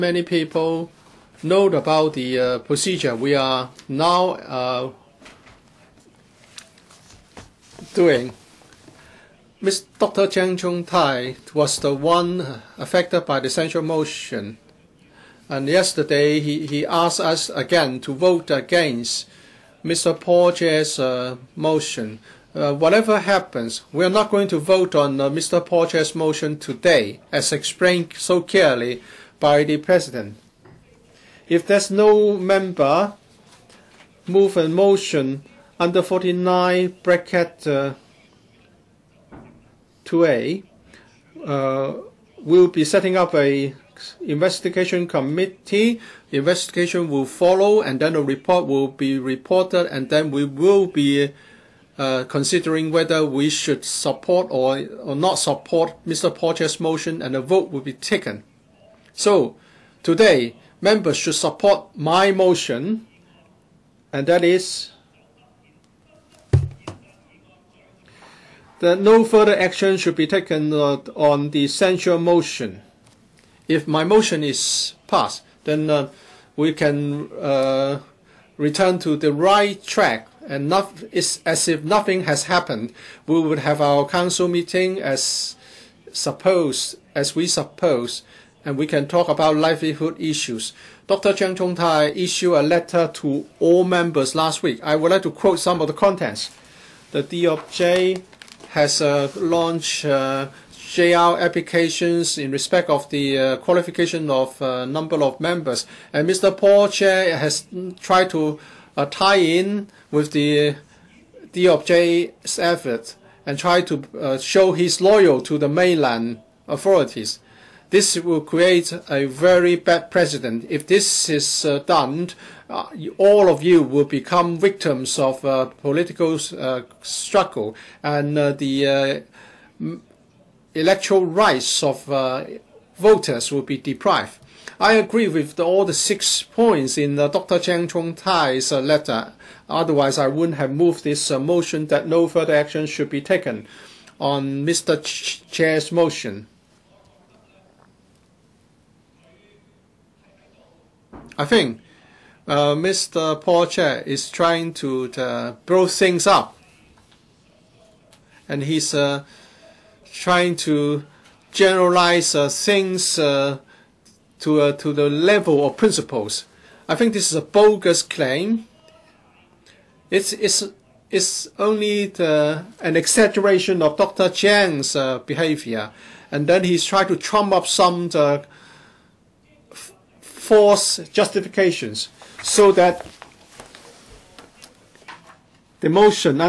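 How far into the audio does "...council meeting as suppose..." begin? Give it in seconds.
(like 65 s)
84 s.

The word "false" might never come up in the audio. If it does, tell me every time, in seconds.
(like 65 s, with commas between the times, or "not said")
180 s.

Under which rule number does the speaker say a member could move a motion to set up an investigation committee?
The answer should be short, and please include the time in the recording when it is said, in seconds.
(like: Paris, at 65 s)
49(2A), at 36 s.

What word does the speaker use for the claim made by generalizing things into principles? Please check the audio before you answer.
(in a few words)
bogus.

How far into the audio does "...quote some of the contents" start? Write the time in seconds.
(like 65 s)
95 s.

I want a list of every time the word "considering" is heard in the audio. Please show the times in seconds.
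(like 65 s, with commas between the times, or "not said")
52 s.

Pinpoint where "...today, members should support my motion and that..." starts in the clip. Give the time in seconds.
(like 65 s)
60 s.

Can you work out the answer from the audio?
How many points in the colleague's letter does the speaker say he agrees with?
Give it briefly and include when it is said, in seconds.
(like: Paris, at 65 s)
6, at 135 s.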